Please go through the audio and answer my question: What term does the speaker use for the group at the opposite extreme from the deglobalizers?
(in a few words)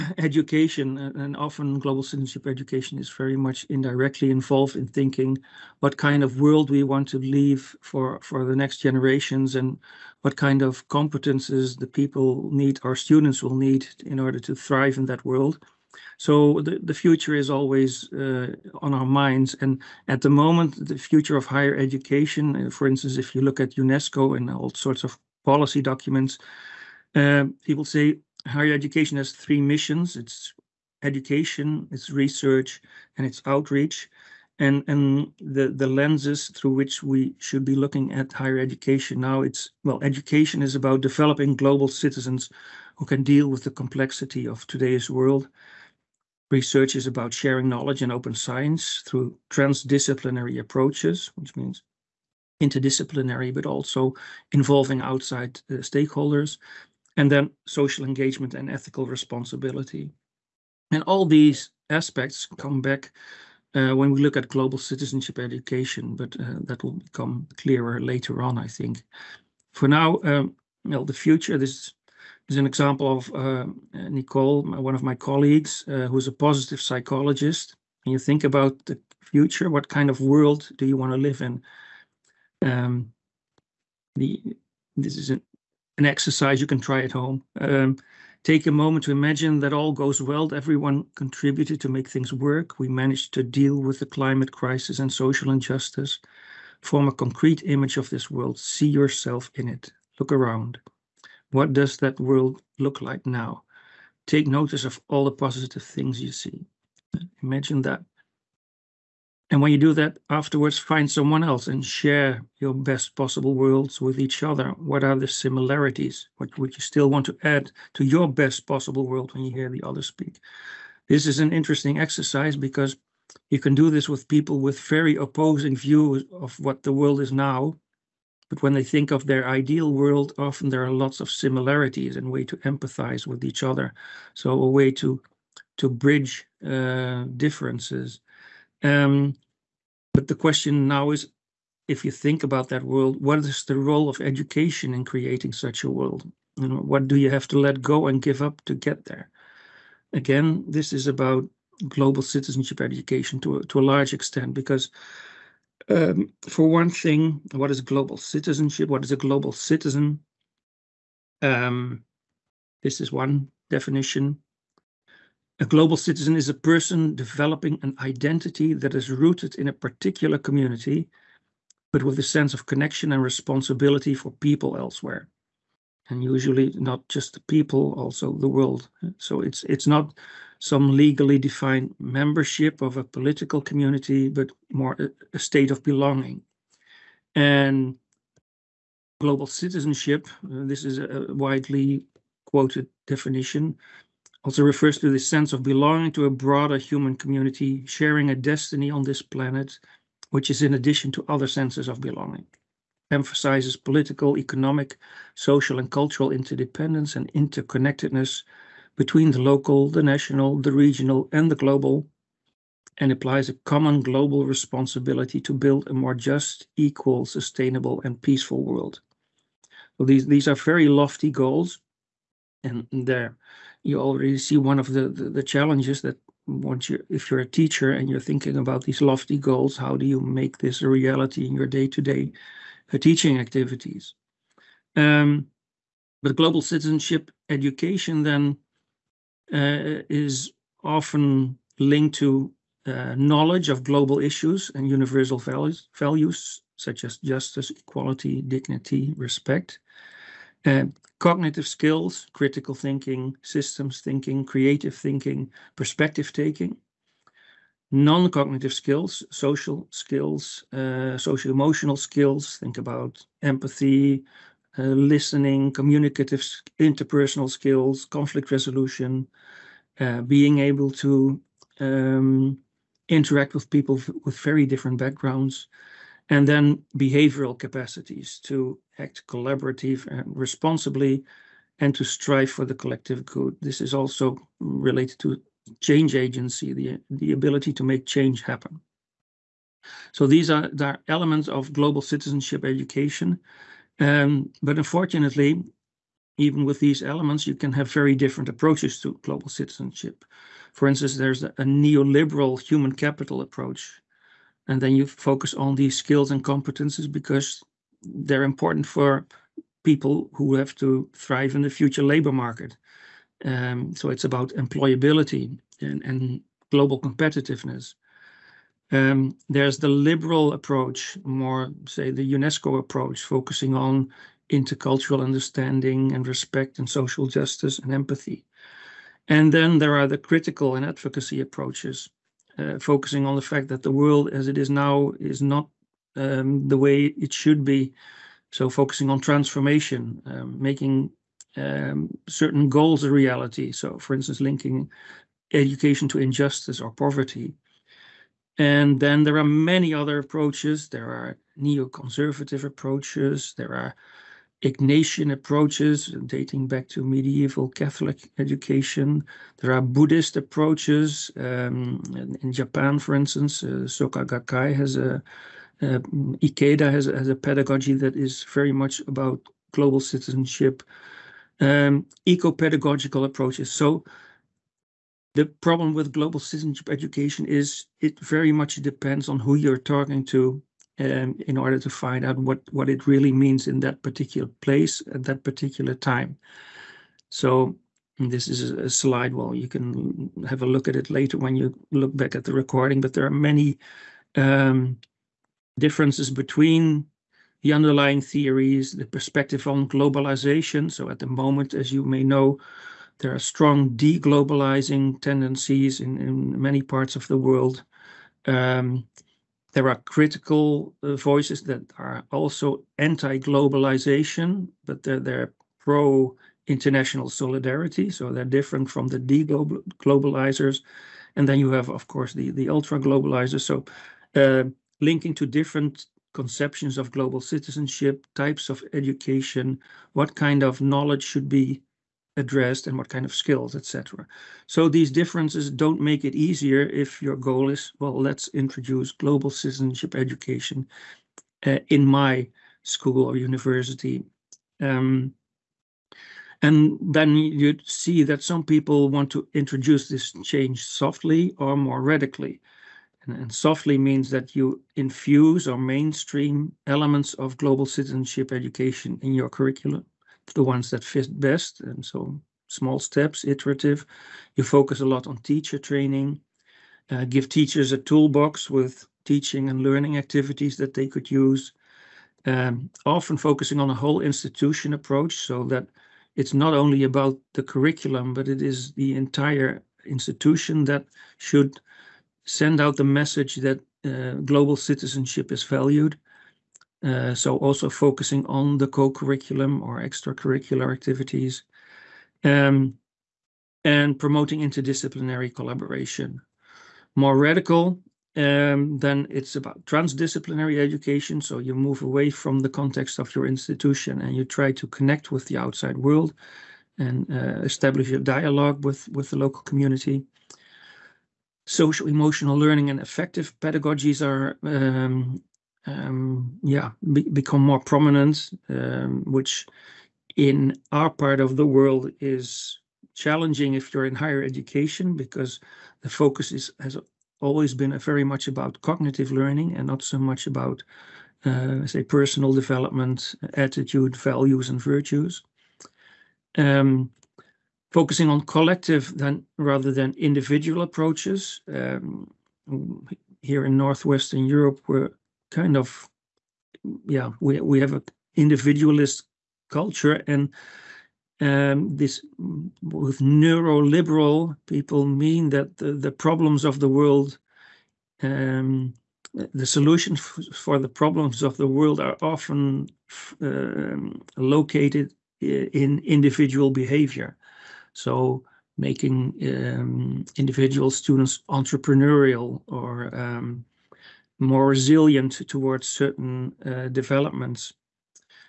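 Ultra globalizers.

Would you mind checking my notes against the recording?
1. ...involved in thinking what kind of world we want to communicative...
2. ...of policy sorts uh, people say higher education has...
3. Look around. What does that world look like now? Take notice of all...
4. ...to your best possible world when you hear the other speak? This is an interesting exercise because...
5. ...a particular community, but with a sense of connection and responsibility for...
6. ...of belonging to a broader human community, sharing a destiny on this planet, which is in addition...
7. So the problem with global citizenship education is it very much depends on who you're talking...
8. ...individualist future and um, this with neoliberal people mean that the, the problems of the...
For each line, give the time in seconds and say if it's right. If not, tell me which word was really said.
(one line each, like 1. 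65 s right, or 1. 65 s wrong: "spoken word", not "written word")
1. 4 s wrong: "leave", not "communicative"
2. 25 s wrong: "documents", not "sorts"
3. 100 s right
4. 117 s right
5. 169 s right
6. 195 s right
7. 373 s right
8. 548 s wrong: "culture", not "future".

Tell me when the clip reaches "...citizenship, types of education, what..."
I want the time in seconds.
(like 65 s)
427 s.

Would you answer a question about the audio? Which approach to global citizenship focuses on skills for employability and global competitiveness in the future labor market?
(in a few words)
Neoliberal human capital approach.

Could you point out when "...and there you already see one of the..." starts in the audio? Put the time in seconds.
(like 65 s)
222 s.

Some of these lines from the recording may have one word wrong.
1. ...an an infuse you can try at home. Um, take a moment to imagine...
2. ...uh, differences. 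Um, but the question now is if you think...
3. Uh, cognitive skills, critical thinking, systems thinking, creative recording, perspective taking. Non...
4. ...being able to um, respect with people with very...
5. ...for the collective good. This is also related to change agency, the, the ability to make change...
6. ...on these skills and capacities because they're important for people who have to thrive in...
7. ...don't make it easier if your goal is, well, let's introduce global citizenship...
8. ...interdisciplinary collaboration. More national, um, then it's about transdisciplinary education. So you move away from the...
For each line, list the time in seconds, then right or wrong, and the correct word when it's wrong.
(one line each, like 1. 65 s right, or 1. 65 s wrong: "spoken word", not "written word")
1. 85 s wrong: "exercise", not "infuse"
2. 136 s right
3. 250 s wrong: "thinking", not "recording"
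4. 270 s wrong: "interact", not "respect"
5. 282 s right
6. 305 s wrong: "competences", not "capacities"
7. 435 s right
8. 494 s wrong: "radical", not "national".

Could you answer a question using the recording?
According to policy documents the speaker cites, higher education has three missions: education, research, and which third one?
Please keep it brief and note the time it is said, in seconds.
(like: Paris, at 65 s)
Outreach, at 33 s.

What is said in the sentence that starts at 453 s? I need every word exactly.
And, and softly means that you infuse or mainstream elements of global citizenship education in your curriculum the ones that fit best.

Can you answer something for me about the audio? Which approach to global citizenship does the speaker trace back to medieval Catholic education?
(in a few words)
Ignatian.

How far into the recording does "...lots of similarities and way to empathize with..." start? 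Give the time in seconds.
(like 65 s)
130 s.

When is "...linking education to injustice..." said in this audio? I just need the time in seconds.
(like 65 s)
344 s.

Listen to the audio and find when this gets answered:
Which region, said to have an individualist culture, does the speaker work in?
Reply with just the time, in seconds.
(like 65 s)
543 s.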